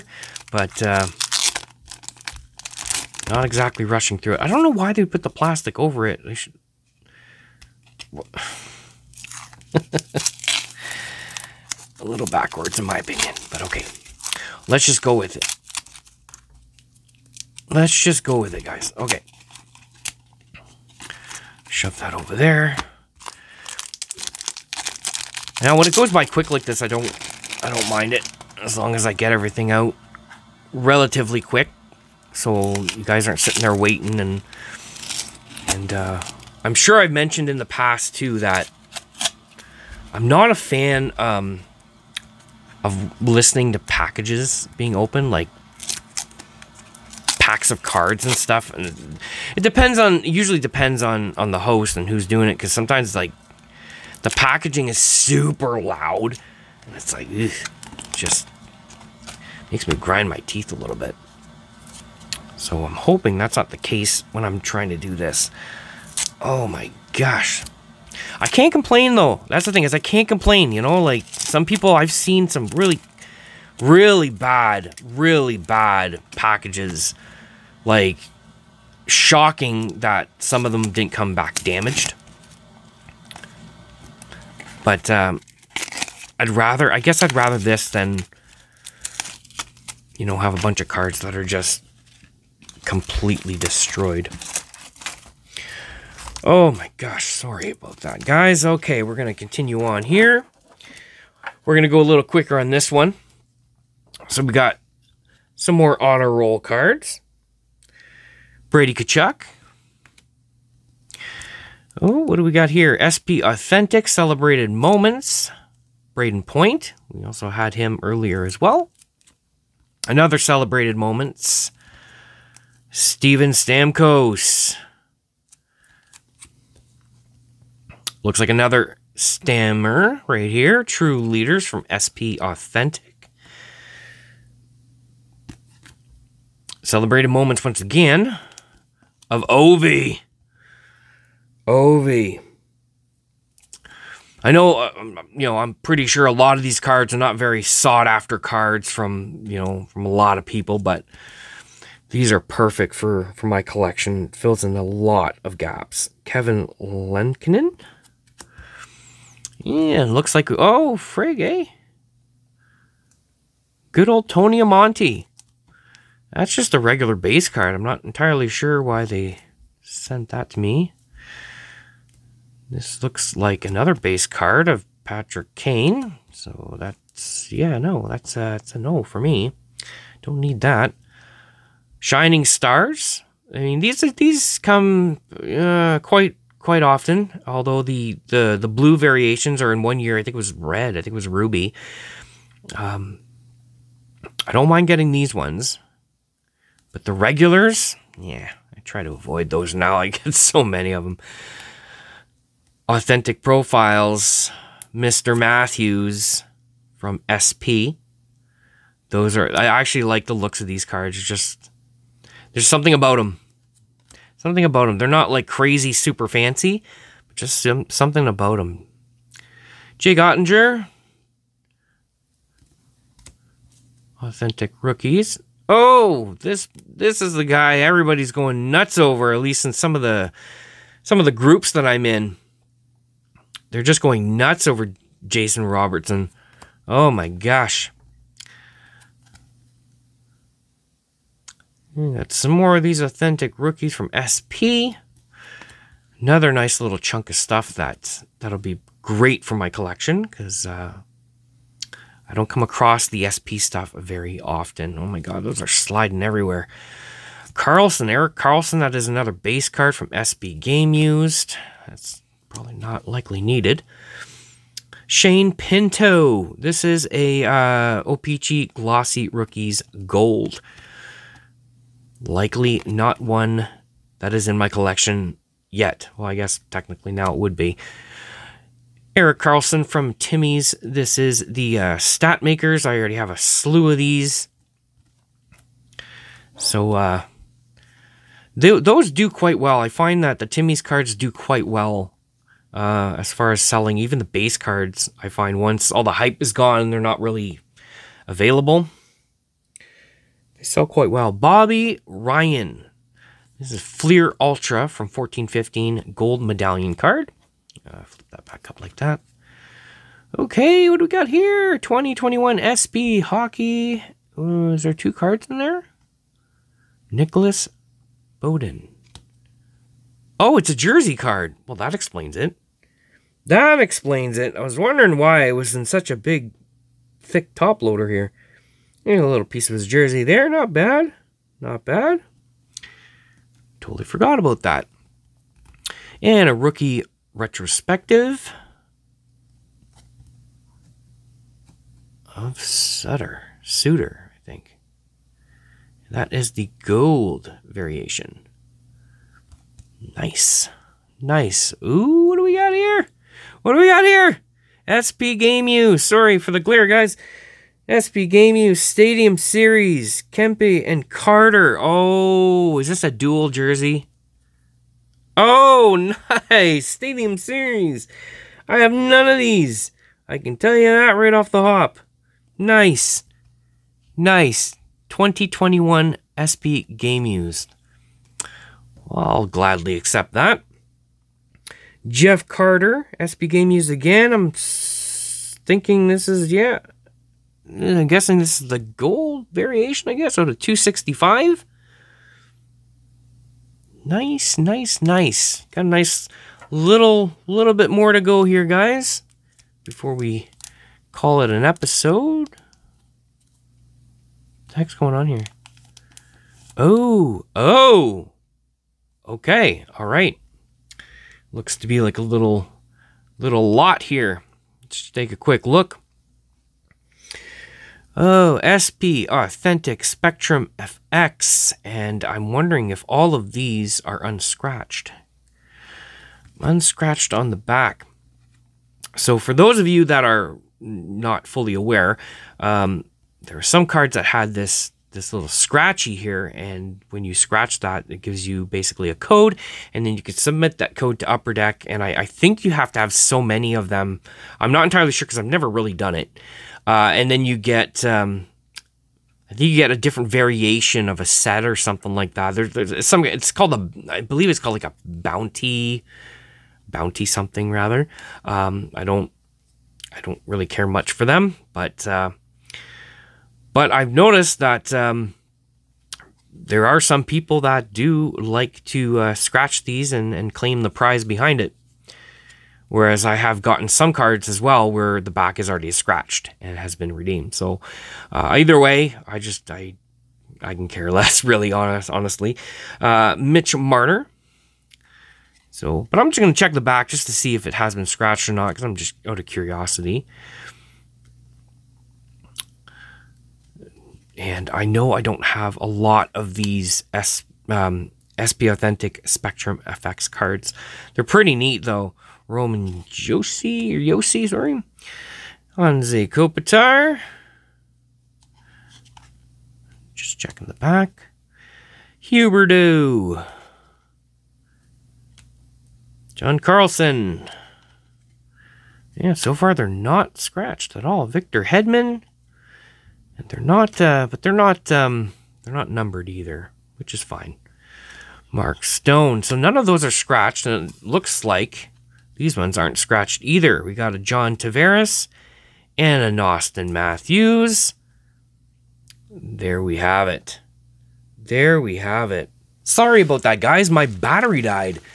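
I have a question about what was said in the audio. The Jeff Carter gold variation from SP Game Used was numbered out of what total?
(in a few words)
265.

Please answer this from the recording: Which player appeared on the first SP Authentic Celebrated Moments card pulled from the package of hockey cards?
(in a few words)
Brayden Point.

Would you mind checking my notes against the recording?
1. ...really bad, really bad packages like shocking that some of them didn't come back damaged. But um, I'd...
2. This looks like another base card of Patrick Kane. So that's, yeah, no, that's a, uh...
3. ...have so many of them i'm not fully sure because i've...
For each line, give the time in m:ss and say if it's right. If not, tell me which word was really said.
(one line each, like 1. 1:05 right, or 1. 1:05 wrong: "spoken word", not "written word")
1. 1:13 right
2. 2:52 right
3. 7:22 wrong: "entirely", not "fully".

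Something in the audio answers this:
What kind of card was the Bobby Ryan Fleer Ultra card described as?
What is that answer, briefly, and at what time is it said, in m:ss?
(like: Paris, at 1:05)
gold medallion, at 5:06.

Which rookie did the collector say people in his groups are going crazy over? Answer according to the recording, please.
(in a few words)
Jason Robertson.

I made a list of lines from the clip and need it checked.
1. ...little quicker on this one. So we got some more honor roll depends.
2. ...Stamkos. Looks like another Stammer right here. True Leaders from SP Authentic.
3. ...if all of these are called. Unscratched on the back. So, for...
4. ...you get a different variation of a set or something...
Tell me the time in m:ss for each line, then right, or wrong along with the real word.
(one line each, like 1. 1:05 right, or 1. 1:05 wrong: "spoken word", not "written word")
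1. 1:42 wrong: "cards", not "depends"
2. 2:03 right
3. 7:02 wrong: "unscratched", not "called"
4. 7:29 right.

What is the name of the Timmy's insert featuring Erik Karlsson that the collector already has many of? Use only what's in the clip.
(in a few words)
Stat Makers.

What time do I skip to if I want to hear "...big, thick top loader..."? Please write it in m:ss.
5:26.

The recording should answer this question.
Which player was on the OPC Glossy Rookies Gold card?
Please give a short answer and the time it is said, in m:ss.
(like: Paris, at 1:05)
Shane Pinto, at 4:25.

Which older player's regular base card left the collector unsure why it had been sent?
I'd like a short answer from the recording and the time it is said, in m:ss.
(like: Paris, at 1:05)
Tony Amonte, at 2:44.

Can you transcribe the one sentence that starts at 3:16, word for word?
But the regulars, yeah, I try to avoid those now.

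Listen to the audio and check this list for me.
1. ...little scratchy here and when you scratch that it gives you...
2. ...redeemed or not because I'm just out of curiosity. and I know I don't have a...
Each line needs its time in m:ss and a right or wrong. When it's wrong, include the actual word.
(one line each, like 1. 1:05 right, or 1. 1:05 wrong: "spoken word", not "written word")
1. 7:15 right
2. 8:08 wrong: "scratched", not "redeemed".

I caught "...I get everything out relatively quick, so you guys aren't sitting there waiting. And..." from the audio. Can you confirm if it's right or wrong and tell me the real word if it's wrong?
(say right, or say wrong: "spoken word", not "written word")
right.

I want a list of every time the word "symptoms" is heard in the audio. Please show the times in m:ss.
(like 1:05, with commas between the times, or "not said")
not said.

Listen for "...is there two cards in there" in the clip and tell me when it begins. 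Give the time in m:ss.
5:14.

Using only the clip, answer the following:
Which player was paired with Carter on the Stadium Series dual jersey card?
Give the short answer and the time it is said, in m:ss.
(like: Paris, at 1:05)
Kempe, at 6:00.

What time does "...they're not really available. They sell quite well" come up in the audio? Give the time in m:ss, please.
4:56.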